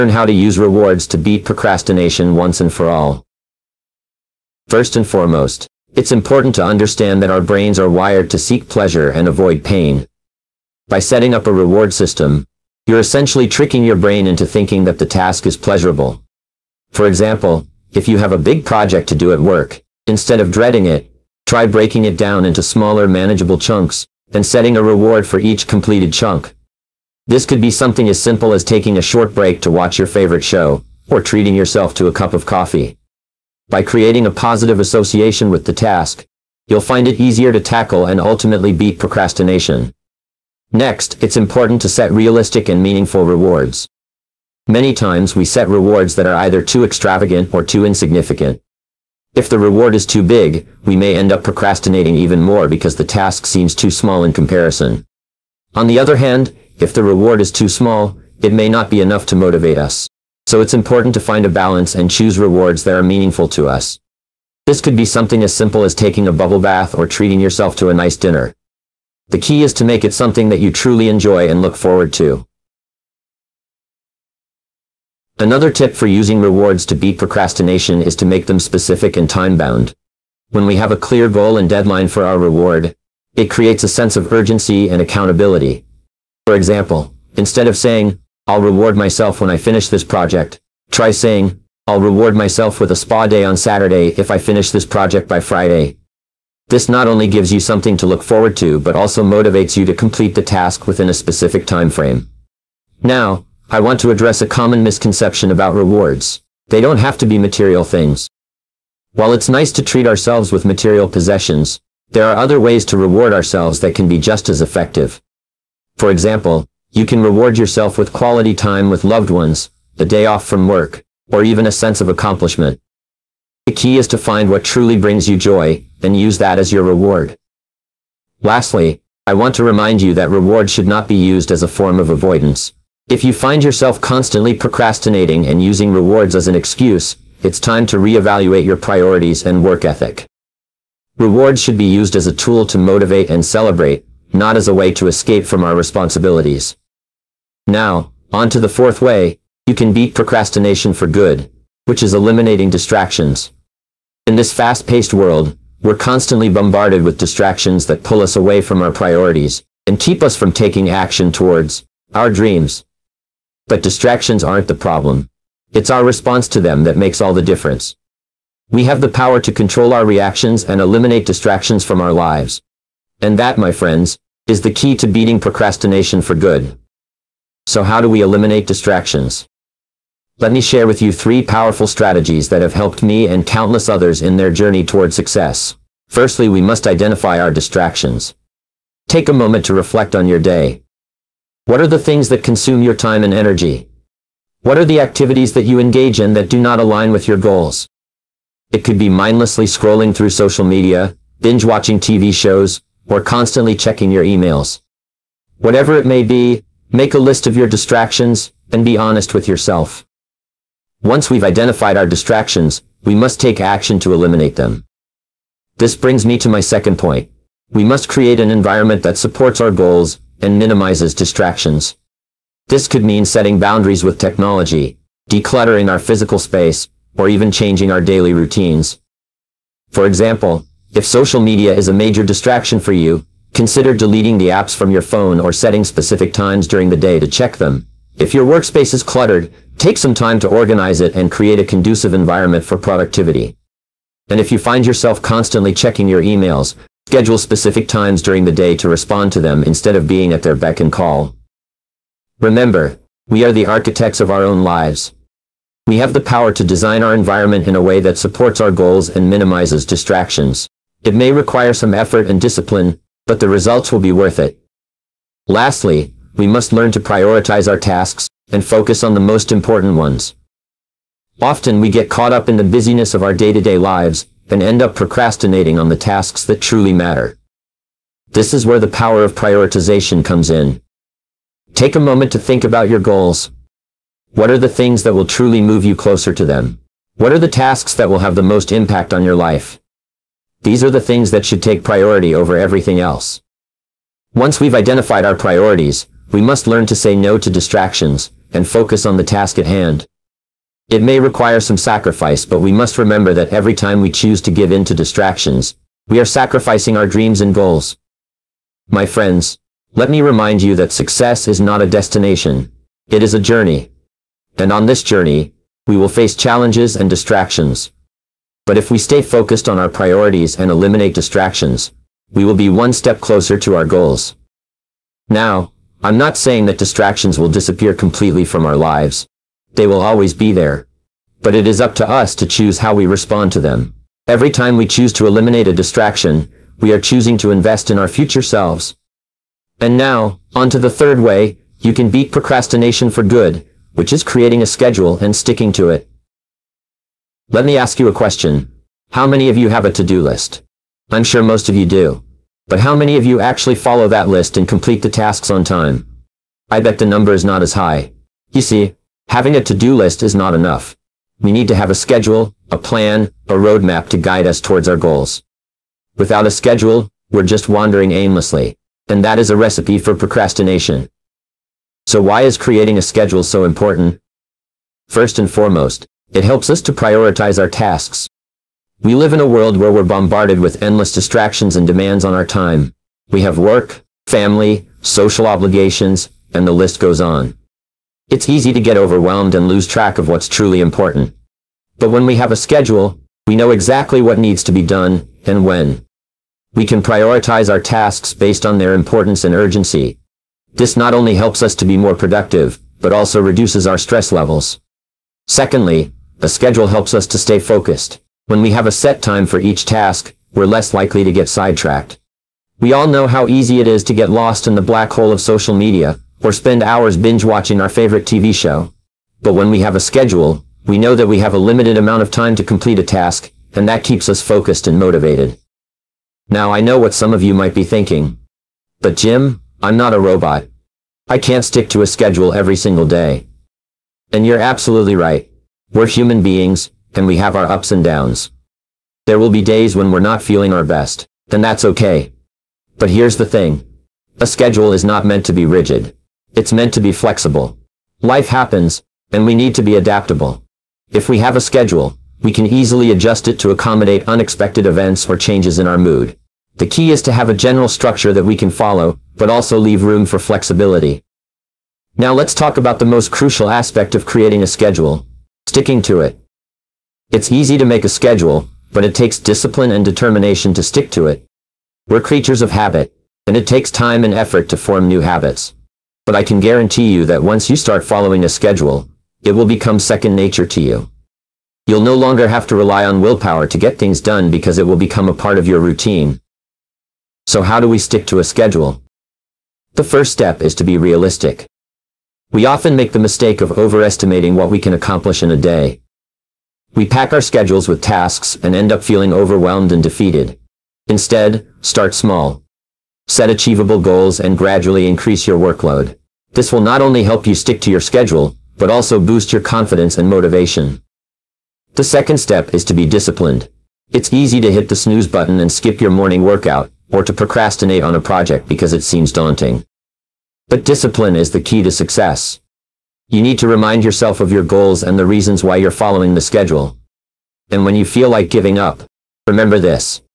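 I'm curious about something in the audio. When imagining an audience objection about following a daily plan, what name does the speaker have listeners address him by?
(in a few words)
Jim.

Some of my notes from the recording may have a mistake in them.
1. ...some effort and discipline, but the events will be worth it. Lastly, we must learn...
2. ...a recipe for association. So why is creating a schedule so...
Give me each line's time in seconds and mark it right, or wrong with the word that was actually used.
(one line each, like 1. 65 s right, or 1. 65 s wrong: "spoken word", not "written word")
1. 261 s wrong: "results", not "events"
2. 369 s wrong: "procrastination", not "association".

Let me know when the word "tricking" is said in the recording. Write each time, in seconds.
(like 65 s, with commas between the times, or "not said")
13 s.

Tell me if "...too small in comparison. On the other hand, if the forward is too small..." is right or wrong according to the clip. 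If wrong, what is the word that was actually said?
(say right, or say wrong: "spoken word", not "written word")
wrong: "reward", not "forward".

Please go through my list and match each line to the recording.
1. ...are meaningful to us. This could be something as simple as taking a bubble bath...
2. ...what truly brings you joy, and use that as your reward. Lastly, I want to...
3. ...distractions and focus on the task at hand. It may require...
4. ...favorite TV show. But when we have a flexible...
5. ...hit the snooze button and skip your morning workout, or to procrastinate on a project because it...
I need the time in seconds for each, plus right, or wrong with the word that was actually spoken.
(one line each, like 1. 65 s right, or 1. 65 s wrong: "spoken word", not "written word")
1. 62 s right
2. 124 s right
3. 297 s right
4. 417 s wrong: "schedule", not "flexible"
5. 514 s right.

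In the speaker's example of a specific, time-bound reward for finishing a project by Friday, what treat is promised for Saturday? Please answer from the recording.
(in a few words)
a spa day.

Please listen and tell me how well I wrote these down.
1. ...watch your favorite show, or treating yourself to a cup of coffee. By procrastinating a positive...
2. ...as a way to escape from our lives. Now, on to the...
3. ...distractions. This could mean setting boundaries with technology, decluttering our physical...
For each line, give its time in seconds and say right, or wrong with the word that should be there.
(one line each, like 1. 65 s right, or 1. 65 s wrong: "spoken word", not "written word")
1. 29 s wrong: "creating", not "procrastinating"
2. 144 s wrong: "responsibilities", not "lives"
3. 221 s right.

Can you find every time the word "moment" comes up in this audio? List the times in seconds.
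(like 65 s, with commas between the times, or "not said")
189 s, 282 s.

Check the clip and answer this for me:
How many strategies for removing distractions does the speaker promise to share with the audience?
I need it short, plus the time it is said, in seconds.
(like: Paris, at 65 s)
3, at 181 s.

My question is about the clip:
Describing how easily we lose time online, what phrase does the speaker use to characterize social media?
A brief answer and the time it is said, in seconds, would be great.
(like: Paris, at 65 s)
the black hole, at 414 s.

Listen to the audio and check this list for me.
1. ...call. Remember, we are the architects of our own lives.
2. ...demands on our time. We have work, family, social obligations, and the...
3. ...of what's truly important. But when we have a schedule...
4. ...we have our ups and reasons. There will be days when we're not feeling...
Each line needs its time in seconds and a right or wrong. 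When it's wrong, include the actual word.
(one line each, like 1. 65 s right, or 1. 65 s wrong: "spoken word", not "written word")
1. 250 s right
2. 381 s right
3. 390 s right
4. 437 s wrong: "downs", not "reasons".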